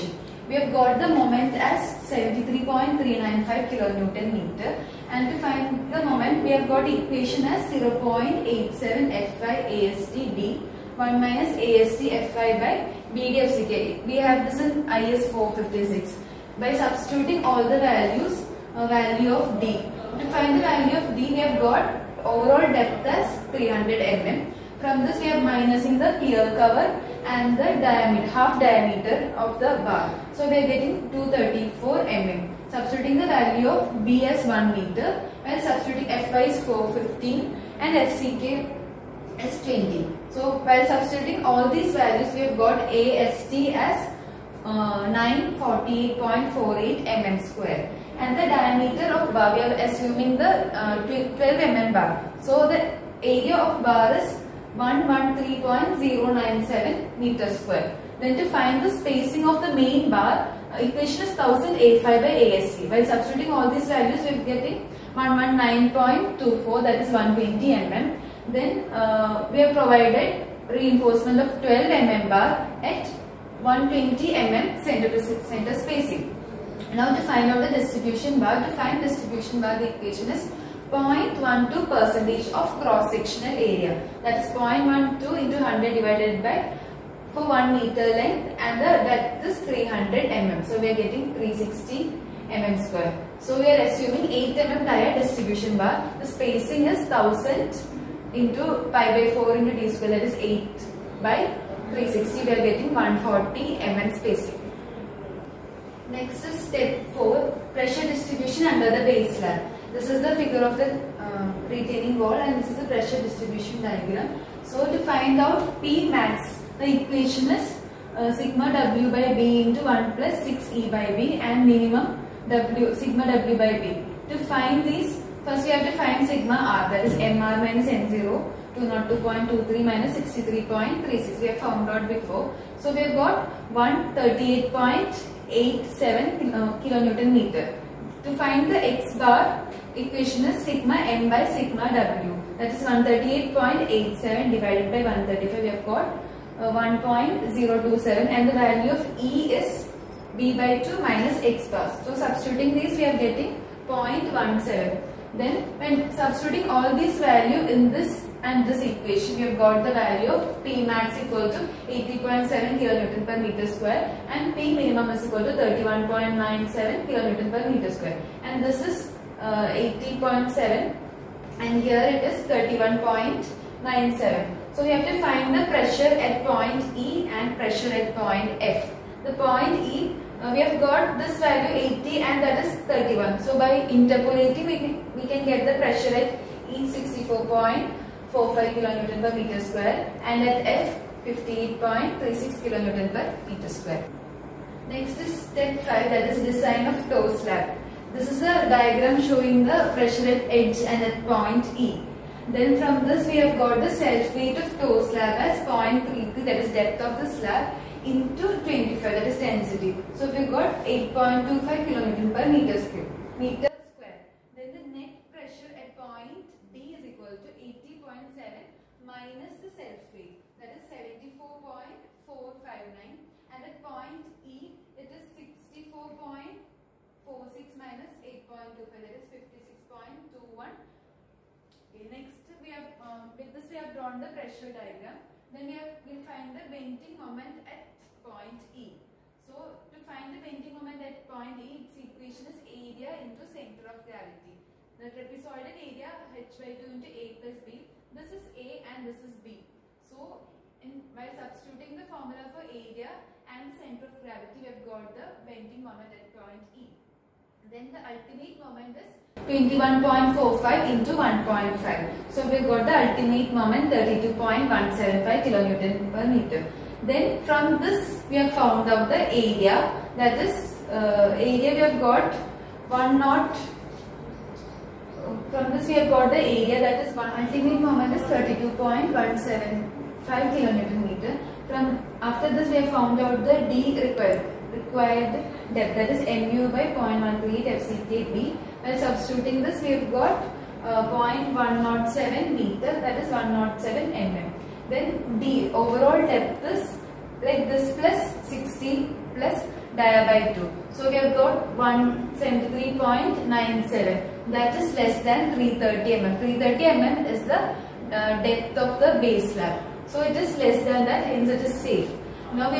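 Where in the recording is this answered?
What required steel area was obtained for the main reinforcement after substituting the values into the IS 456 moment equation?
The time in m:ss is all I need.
0:45.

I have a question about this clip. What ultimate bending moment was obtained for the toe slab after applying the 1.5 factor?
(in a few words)
32.175 kN·m.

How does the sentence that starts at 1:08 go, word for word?
Then uh, we have provided reinforcement of 12 mm bar at 120 mm center to center spacing.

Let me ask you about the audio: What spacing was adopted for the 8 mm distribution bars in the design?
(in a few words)
140 mm.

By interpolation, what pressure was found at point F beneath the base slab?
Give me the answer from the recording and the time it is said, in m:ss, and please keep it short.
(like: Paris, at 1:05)
58.36 kN/m², at 3:11.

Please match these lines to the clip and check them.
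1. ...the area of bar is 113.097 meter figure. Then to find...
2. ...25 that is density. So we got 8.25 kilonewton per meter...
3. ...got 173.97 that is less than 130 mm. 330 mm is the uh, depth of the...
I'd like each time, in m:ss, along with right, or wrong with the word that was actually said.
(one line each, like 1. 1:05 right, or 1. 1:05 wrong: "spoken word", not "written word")
1. 0:52 wrong: "square", not "figure"
2. 3:28 right
3. 5:01 wrong: "330", not "130".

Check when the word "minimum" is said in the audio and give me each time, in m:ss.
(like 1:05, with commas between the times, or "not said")
2:01, 2:44.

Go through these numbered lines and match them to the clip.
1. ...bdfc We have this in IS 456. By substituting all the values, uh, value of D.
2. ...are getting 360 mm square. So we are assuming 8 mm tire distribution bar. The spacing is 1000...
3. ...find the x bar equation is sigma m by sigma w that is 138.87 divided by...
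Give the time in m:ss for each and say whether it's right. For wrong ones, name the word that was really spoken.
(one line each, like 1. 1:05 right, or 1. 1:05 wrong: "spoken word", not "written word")
1. 0:13 right
2. 1:30 right
3. 2:18 right.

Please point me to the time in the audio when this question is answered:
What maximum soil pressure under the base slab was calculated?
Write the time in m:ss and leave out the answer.
2:41.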